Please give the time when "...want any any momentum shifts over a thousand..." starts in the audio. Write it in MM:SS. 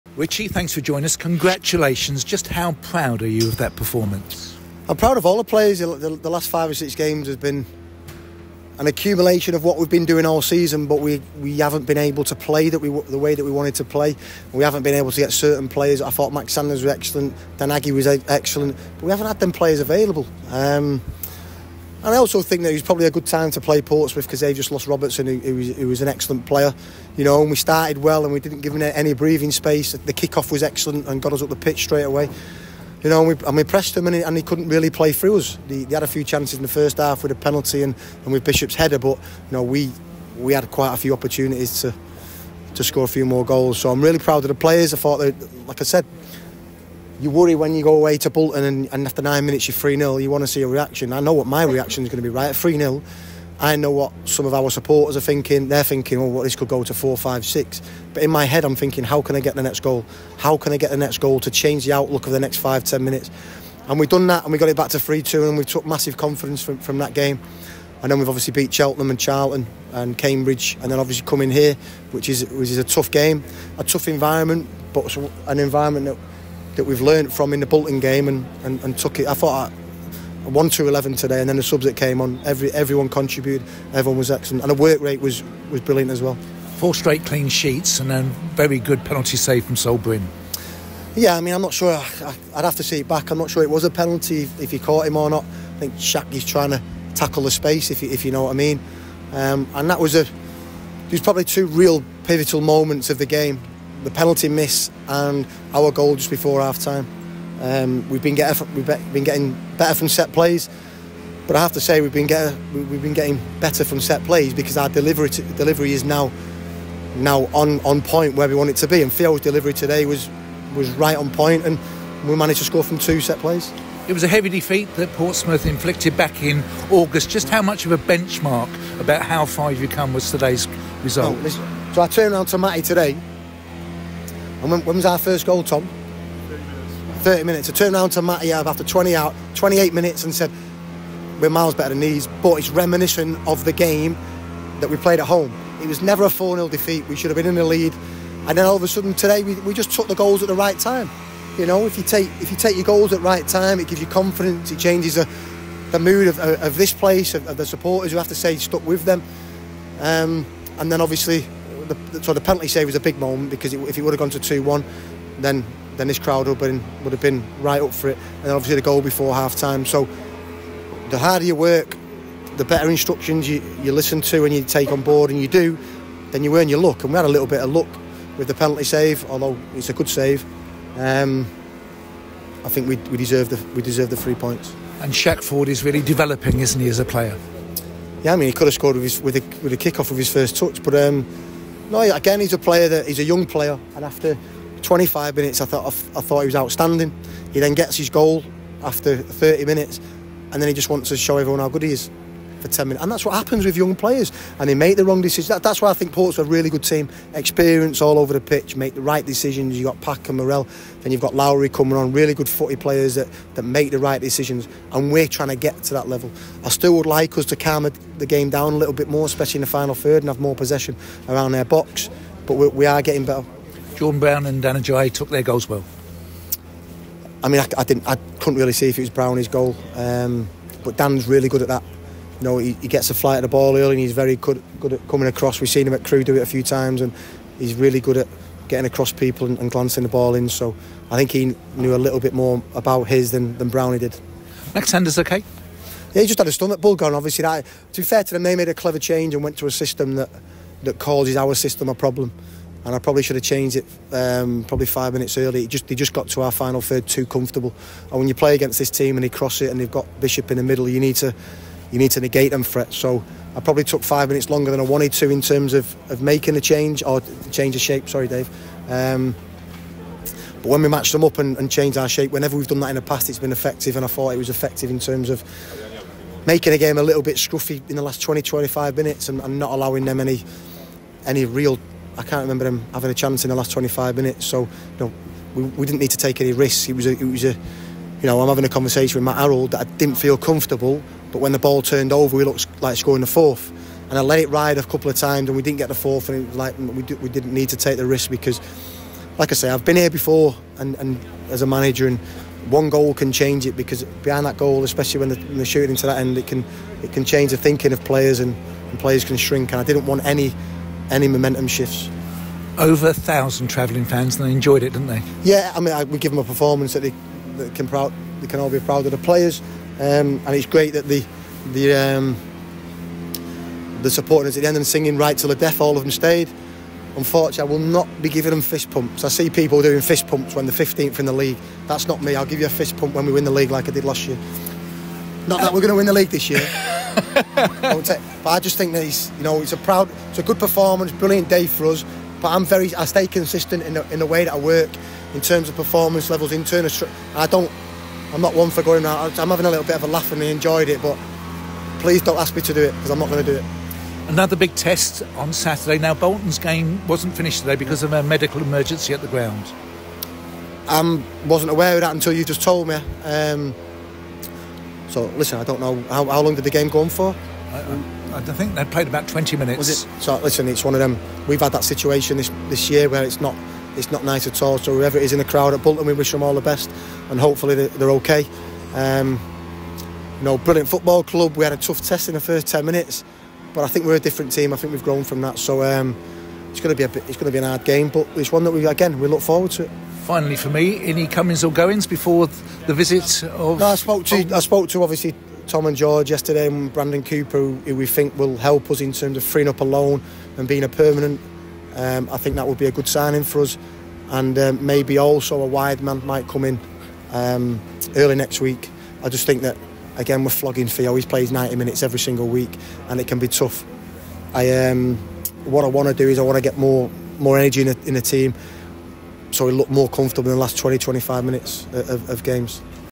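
05:10.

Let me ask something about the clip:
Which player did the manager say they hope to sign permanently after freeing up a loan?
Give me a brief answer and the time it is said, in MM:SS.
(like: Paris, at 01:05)
Brandon Cooper, at 06:36.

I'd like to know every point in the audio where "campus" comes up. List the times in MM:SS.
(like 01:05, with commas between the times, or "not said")
not said.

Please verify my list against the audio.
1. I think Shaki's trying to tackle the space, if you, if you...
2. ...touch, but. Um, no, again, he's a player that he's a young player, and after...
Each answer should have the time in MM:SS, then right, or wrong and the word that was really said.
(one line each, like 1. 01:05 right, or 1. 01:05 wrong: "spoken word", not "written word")
1. 01:35 right
2. 03:10 right.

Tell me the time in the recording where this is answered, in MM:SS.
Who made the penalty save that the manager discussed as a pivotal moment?
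01:29.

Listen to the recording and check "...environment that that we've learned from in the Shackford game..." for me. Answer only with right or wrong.
wrong.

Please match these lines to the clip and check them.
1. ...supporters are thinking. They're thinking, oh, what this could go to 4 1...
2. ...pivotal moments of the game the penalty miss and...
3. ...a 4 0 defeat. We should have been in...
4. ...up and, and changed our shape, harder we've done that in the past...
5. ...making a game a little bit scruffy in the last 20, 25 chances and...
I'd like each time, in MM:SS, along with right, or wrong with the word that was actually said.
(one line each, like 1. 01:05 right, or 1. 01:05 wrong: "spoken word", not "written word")
1. 00:54 wrong: "5", not "1"
2. 01:42 right
3. 02:26 right
4. 04:31 wrong: "whenever", not "harder"
5. 04:36 wrong: "minutes", not "chances".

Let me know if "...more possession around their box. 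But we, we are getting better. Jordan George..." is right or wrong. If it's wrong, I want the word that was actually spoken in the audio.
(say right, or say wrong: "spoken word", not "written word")
wrong: "Brown", not "George".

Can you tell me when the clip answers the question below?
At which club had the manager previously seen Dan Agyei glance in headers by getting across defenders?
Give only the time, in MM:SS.
03:56.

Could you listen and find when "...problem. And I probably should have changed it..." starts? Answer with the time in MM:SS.
04:11.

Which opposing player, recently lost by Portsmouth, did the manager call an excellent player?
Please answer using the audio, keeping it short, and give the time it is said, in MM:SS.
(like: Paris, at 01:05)
Robertson, at 00:24.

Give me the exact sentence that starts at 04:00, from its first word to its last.
So I think he knew a little bit more about his than, than Brownie did.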